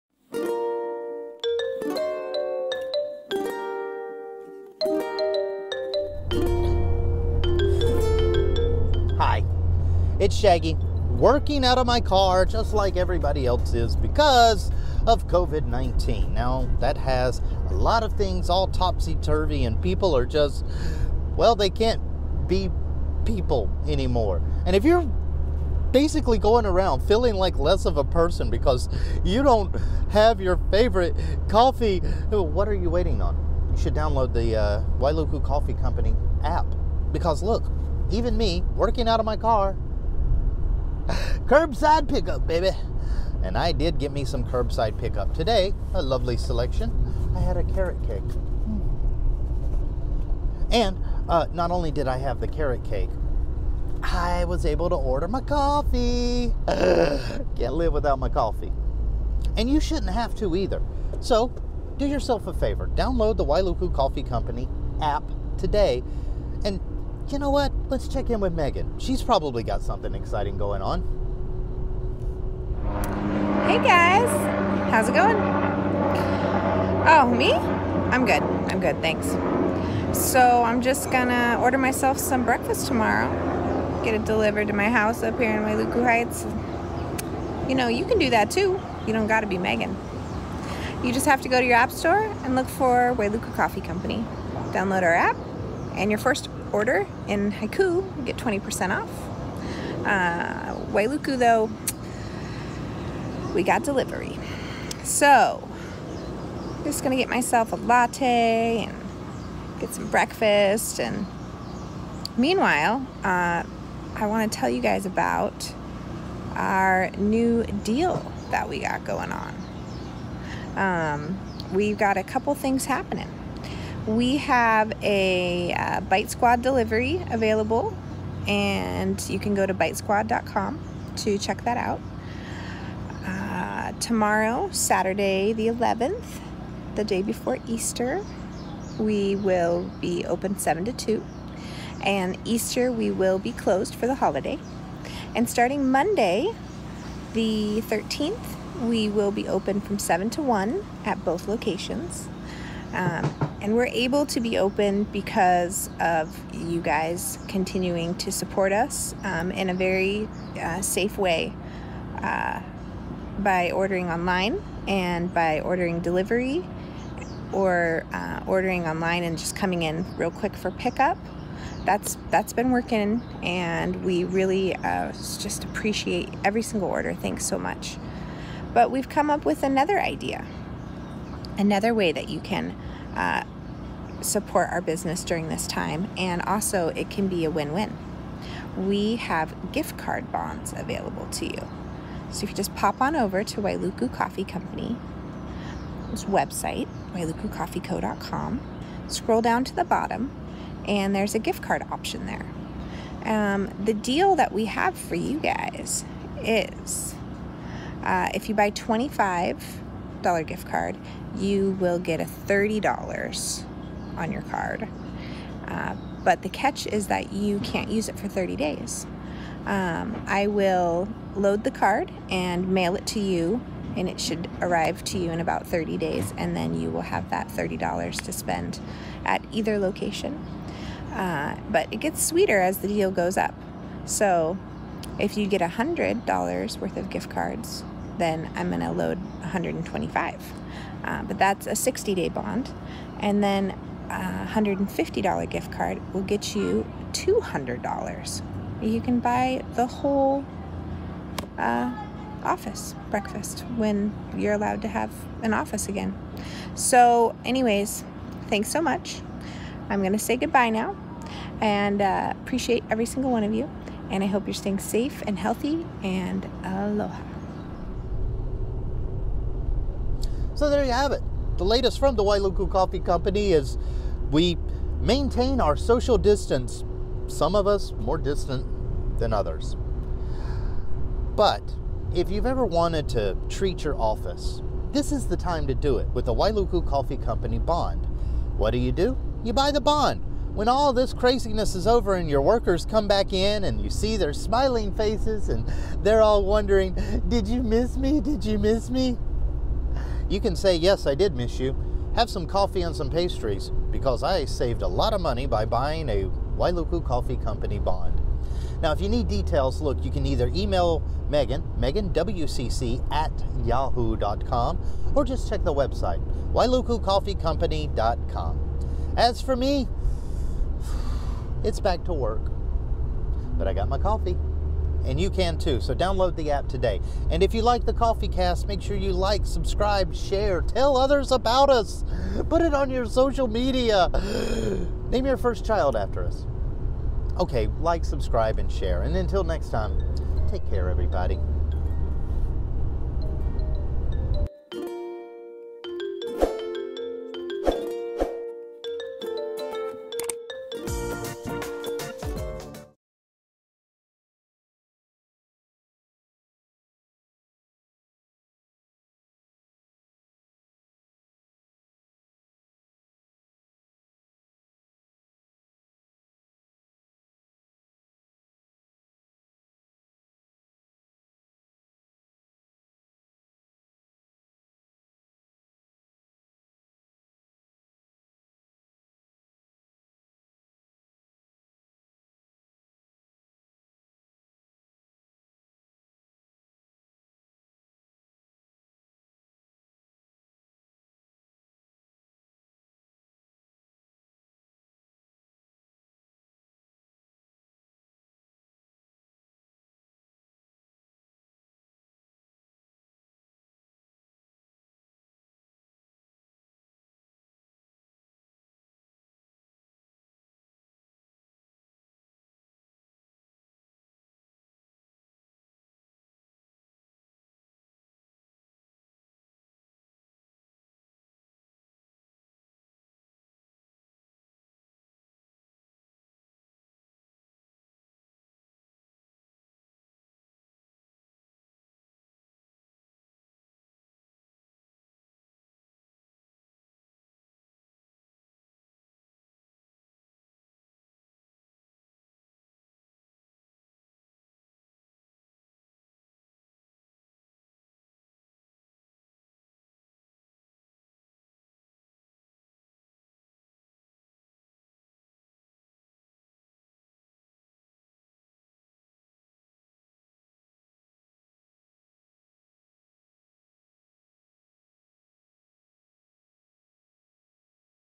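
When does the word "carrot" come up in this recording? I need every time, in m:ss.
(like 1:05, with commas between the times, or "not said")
0:47, 0:52.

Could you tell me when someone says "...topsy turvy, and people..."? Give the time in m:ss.
0:18.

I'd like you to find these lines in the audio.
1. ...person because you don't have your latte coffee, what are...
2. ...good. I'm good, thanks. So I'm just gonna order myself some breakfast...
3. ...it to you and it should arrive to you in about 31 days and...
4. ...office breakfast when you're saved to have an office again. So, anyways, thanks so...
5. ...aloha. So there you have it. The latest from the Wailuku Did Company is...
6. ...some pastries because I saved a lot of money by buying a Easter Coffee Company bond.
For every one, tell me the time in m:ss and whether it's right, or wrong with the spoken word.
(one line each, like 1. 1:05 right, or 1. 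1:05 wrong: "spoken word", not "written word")
1. 0:28 wrong: "favorite", not "latte"
2. 1:18 right
3. 3:42 wrong: "30", not "31"
4. 4:12 wrong: "allowed", not "saved"
5. 4:26 wrong: "Coffee", not "Did"
6. 5:02 wrong: "Wailuku", not "Easter".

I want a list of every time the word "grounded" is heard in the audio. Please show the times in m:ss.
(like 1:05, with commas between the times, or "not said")
not said.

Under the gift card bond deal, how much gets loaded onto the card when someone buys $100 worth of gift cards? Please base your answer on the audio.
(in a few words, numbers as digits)
$125.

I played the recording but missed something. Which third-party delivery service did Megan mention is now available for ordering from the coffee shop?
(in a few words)
Bite Squad.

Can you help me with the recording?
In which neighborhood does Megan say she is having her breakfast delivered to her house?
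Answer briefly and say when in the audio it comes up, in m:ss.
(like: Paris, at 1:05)
Wailuku Heights, at 1:25.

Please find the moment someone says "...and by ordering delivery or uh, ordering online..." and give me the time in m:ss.
2:44.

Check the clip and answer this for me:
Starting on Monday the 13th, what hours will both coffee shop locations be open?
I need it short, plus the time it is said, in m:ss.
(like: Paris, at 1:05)
7 to 1, at 2:29.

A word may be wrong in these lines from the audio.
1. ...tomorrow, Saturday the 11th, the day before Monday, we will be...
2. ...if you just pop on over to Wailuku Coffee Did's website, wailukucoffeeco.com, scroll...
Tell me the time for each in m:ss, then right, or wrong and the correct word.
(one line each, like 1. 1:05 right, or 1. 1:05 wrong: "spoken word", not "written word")
1. 2:13 wrong: "Easter", not "Monday"
2. 3:12 wrong: "Company", not "Did".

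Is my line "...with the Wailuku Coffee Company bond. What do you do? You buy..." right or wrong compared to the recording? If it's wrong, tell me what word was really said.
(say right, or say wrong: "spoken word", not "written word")
right.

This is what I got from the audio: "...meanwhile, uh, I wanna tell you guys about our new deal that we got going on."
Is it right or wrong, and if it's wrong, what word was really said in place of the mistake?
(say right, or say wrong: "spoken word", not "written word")
right.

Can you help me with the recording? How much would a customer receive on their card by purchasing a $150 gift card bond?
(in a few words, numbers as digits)
$200.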